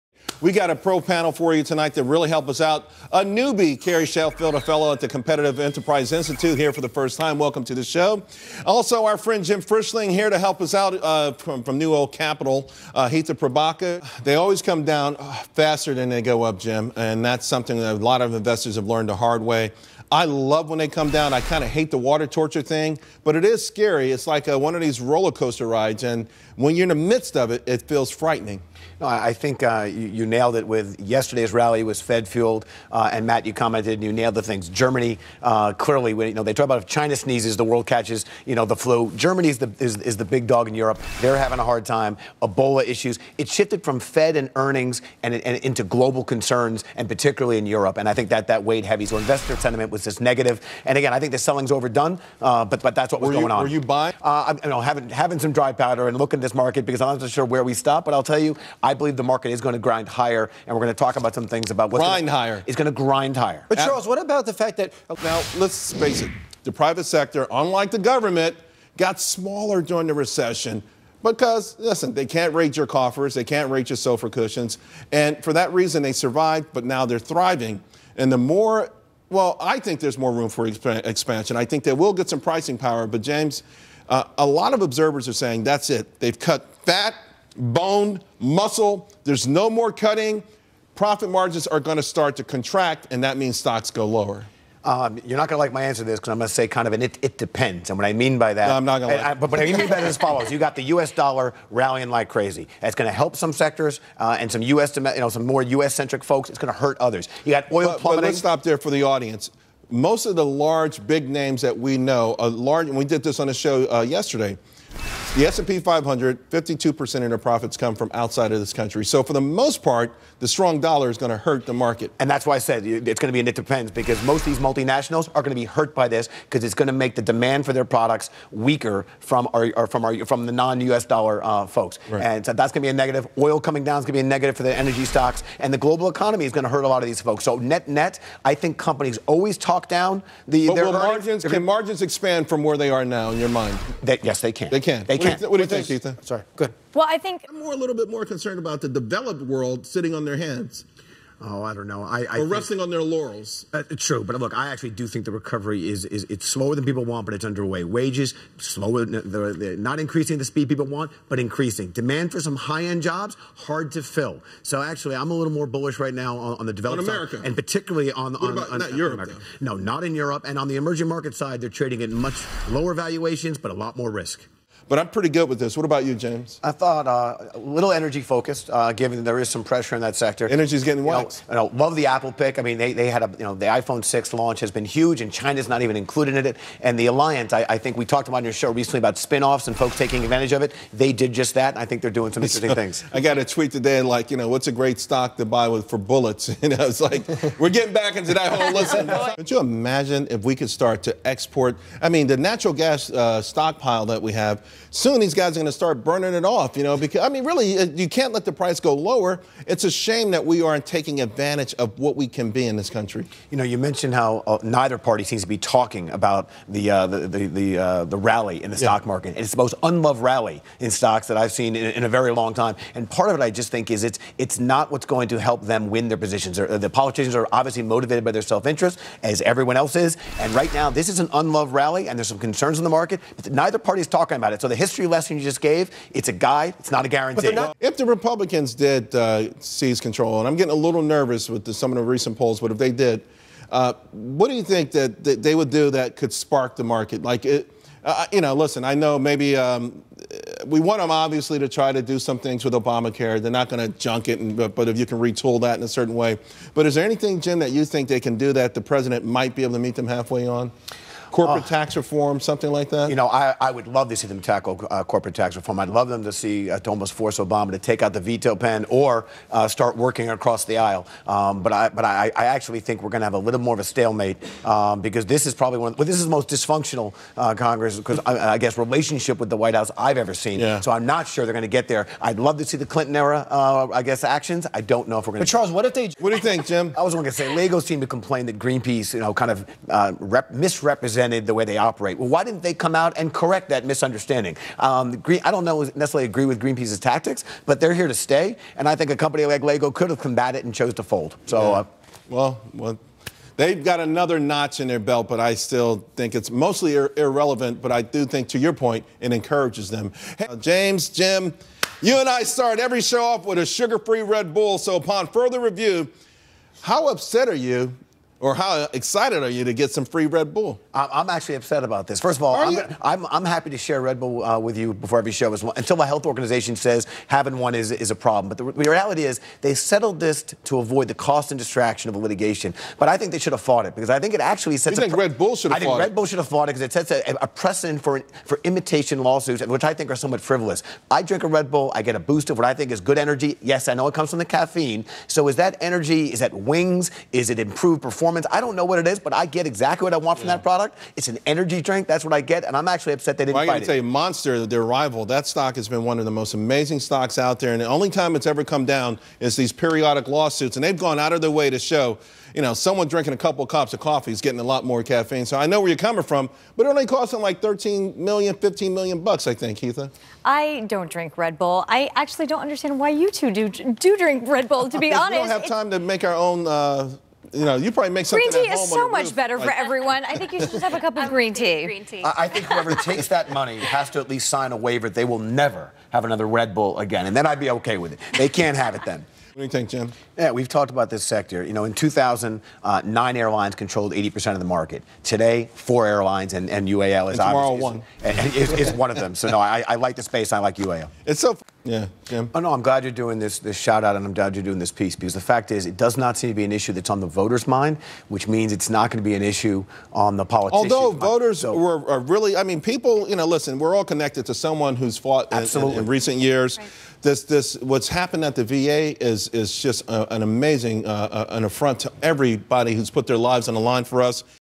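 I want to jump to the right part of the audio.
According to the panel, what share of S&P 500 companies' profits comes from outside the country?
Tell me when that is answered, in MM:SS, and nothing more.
01:56.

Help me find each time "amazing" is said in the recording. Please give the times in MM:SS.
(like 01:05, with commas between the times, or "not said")
05:56, 07:00.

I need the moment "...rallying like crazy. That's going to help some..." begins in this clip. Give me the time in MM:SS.
01:41.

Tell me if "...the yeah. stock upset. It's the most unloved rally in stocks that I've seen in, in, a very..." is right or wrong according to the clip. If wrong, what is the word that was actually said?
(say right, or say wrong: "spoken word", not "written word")
wrong: "market", not "upset".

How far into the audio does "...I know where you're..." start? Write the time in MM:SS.
06:05.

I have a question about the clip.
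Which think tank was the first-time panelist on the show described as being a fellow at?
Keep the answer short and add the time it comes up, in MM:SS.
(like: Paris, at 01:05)
Competitive Enterprise Institute, at 00:05.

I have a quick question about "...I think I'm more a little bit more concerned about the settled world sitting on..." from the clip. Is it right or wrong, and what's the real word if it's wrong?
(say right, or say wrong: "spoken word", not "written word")
wrong: "developed", not "settled".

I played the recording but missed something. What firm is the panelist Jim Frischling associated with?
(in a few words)
NewOak Capital.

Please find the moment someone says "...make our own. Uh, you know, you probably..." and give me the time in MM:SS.
06:15.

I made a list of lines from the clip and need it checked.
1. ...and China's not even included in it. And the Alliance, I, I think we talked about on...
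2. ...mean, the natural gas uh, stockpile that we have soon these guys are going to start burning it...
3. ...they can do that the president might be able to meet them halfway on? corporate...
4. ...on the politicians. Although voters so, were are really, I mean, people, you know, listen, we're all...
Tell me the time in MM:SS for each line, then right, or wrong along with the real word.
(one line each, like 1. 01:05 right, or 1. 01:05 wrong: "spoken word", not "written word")
1. 03:05 right
2. 03:22 right
3. 04:18 right
4. 06:50 right.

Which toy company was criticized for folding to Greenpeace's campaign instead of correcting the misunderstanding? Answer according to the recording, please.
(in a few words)
Lego.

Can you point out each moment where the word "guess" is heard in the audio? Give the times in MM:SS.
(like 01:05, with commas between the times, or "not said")
04:38, 04:44.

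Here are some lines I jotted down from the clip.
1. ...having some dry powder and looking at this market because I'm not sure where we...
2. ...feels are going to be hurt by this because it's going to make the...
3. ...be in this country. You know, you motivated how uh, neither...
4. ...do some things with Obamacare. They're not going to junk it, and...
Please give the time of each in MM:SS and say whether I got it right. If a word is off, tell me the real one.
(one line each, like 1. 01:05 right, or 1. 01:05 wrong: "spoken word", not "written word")
1. 00:55 right
2. 02:04 wrong: "multinationals", not "feels"
3. 03:32 wrong: "mentioned", not "motivated"
4. 04:12 right.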